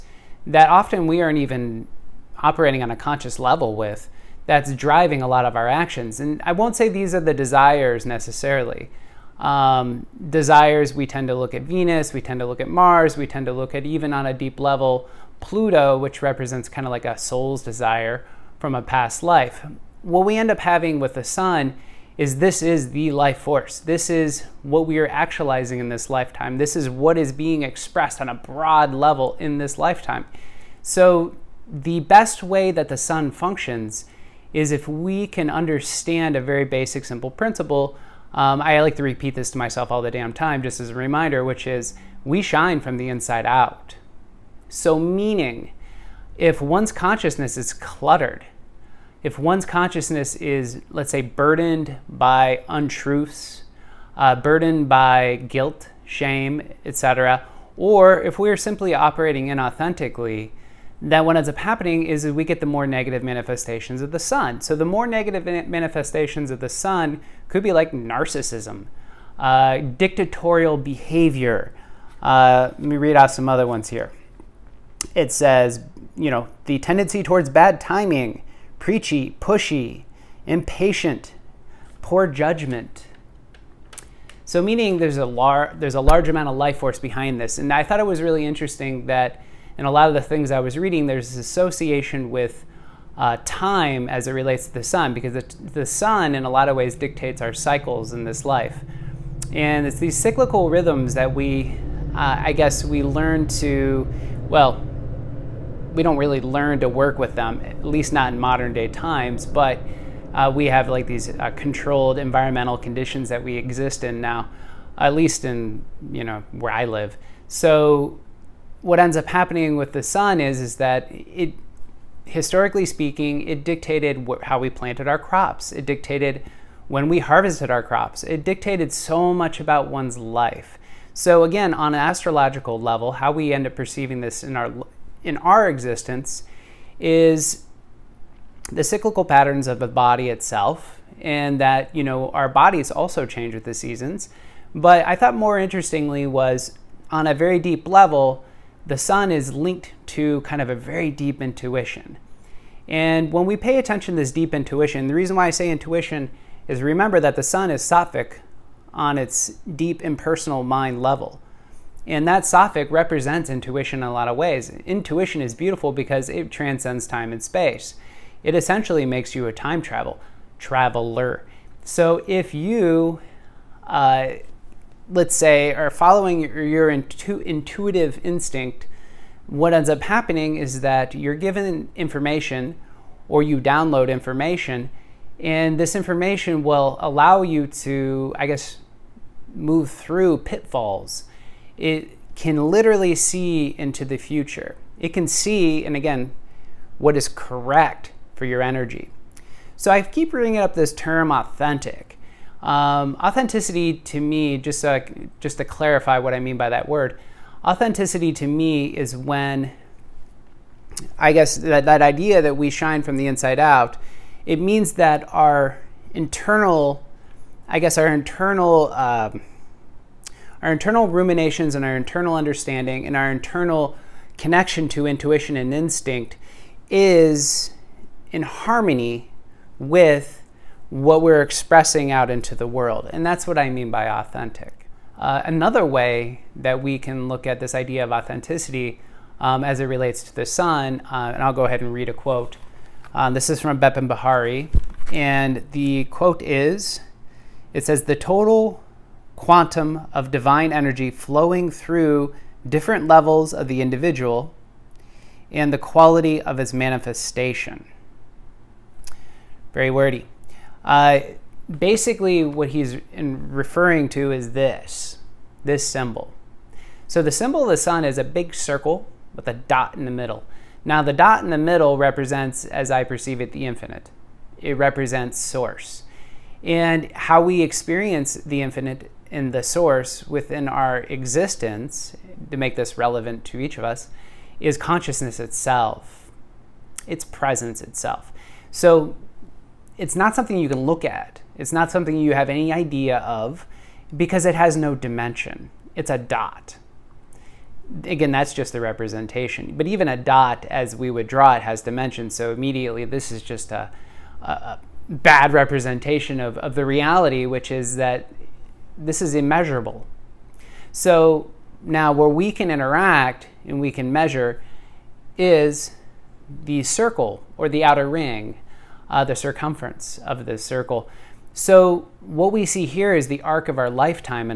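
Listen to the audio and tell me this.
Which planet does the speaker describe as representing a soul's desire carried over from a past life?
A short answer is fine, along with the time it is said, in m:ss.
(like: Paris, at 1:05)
Pluto, at 0:15.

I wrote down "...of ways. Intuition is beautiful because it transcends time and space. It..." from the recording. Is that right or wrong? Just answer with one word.
right.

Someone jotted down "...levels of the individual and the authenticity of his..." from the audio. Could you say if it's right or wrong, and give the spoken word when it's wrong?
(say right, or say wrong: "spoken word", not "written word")
wrong: "quality", not "authenticity".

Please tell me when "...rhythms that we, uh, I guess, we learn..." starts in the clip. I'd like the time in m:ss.
1:40.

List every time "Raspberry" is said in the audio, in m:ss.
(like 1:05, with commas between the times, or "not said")
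not said.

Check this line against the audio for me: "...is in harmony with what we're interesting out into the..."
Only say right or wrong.
wrong.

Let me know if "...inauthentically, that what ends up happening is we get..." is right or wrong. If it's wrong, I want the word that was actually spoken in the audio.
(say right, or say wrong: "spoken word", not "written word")
right.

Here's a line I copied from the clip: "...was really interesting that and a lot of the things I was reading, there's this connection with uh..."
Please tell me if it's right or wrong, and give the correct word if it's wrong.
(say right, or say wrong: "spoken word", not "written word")
wrong: "association", not "connection".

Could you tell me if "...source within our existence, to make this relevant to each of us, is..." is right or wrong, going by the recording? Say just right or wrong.
right.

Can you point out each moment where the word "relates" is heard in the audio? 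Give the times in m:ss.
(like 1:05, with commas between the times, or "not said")
1:34, 3:59.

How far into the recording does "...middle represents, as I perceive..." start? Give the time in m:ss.
4:31.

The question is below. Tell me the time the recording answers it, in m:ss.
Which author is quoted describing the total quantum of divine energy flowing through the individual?
4:03.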